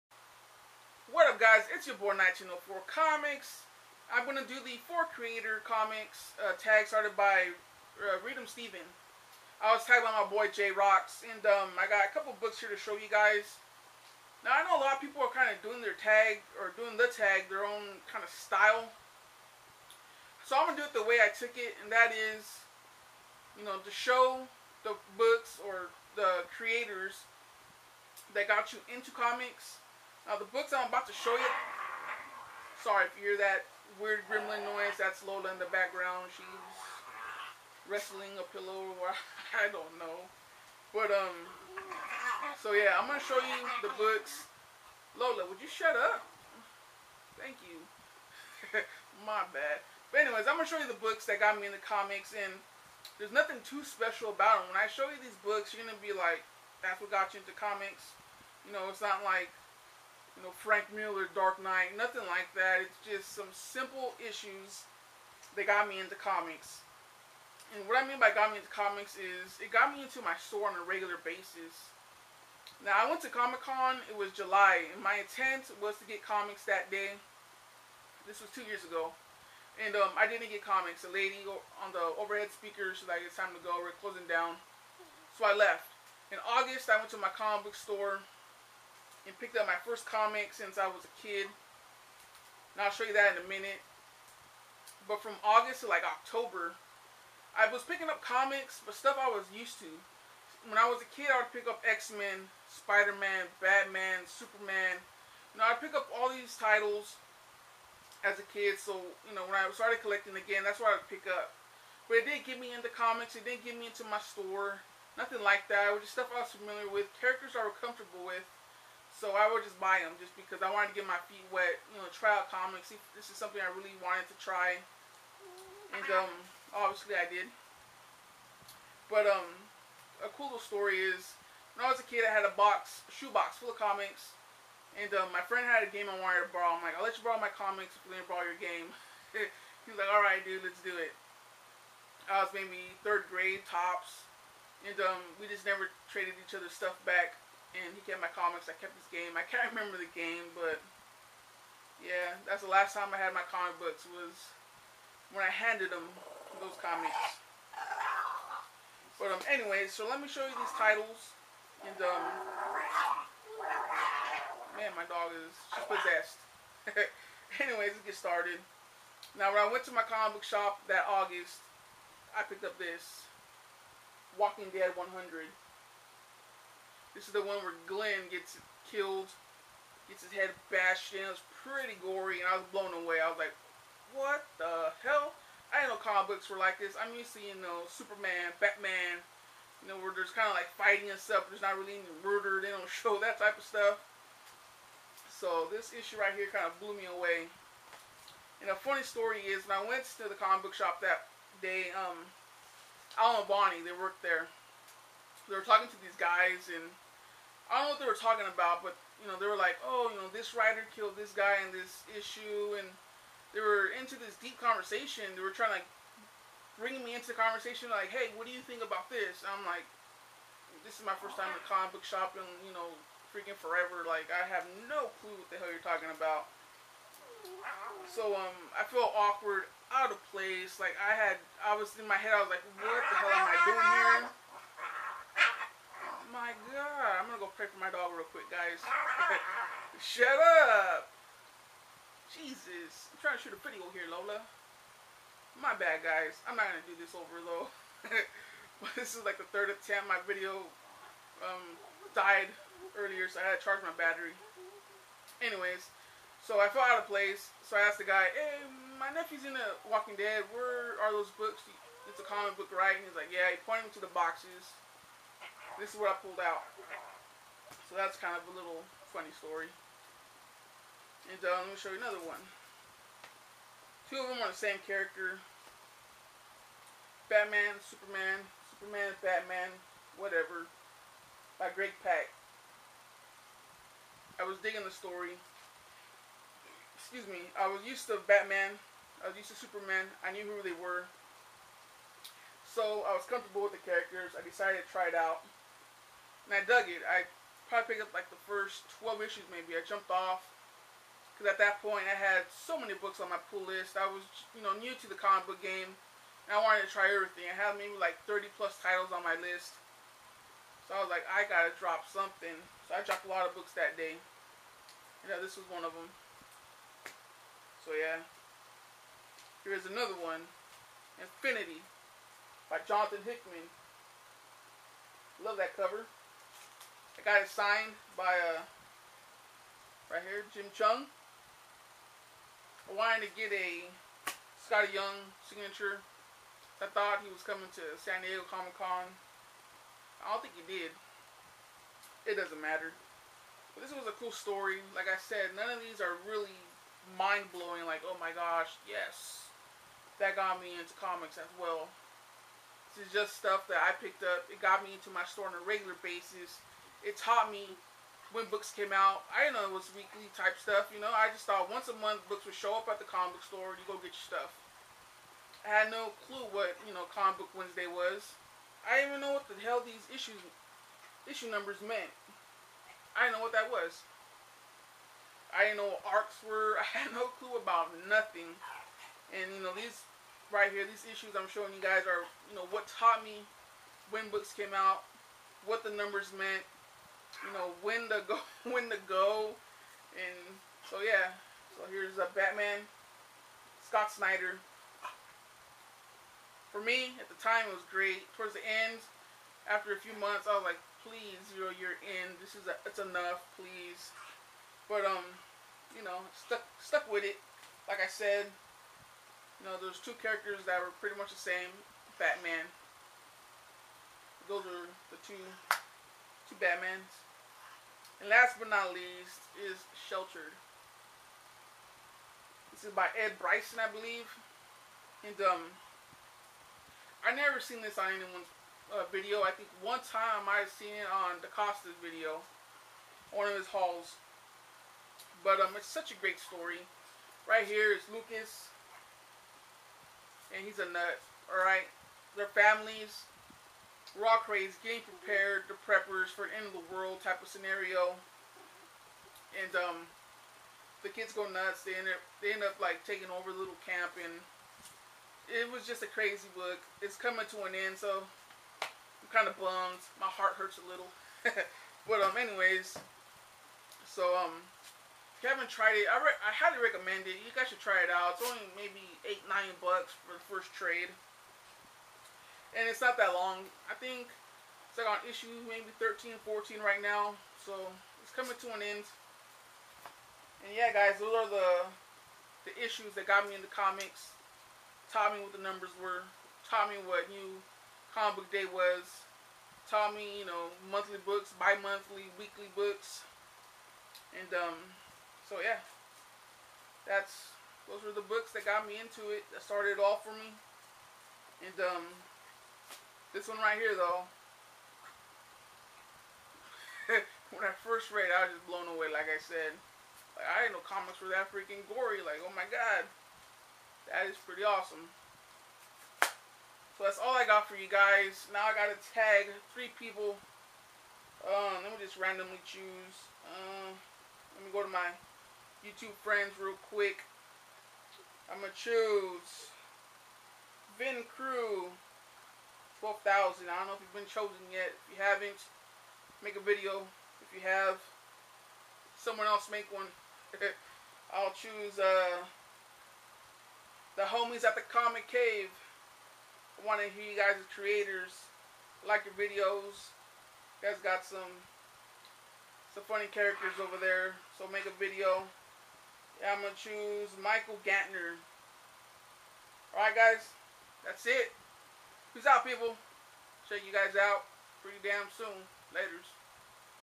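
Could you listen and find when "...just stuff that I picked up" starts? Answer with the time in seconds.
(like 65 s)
353 s.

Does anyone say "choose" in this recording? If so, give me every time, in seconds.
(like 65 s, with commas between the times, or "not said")
522 s, 528 s, 541 s, 556 s.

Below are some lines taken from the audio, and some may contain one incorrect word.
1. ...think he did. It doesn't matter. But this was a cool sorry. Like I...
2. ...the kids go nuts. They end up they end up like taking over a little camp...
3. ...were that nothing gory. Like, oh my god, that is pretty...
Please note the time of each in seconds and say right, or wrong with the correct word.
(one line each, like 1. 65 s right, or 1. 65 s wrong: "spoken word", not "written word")
1. 340 s wrong: "story", not "sorry"
2. 451 s right
3. 511 s wrong: "freaking", not "nothing".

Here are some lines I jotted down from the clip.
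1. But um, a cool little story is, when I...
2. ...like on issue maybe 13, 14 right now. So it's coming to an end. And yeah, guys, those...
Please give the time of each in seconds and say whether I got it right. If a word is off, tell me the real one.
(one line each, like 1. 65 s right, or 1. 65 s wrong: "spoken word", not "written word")
1. 129 s right
2. 474 s right.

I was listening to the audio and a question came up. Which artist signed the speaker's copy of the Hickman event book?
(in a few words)
Jim Cheung.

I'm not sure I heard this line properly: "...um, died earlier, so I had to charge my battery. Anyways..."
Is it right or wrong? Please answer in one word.
right.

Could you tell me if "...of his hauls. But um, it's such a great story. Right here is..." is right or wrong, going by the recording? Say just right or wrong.
right.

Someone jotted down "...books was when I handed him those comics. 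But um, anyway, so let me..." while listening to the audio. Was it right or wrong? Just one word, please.
right.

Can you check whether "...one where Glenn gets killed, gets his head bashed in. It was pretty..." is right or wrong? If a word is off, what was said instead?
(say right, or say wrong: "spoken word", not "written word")
right.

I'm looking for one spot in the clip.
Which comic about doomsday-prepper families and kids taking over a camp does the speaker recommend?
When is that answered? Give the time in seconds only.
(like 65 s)
420 s.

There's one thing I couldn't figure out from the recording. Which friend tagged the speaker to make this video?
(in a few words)
J Rocks.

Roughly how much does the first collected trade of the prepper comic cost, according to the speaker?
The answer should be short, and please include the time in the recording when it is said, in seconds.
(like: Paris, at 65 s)
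8 or 9 dollars, at 469 s.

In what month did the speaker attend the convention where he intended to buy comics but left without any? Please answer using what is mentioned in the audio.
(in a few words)
July.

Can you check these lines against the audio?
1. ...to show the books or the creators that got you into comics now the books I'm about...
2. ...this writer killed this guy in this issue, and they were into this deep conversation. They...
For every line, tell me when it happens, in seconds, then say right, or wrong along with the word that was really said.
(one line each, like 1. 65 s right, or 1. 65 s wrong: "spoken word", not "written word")
1. 23 s right
2. 210 s right.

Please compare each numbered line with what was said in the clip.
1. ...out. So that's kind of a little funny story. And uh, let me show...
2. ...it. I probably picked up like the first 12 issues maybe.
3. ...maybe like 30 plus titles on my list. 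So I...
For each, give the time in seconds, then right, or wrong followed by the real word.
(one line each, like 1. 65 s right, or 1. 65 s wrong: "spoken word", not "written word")
1. 266 s right
2. 296 s right
3. 307 s right.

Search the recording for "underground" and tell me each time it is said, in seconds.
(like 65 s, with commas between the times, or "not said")
not said.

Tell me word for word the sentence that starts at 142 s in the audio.
I was maybe third grade, tops.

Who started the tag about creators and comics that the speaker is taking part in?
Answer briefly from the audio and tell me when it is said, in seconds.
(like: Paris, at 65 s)
Readem Steven, at 8 s.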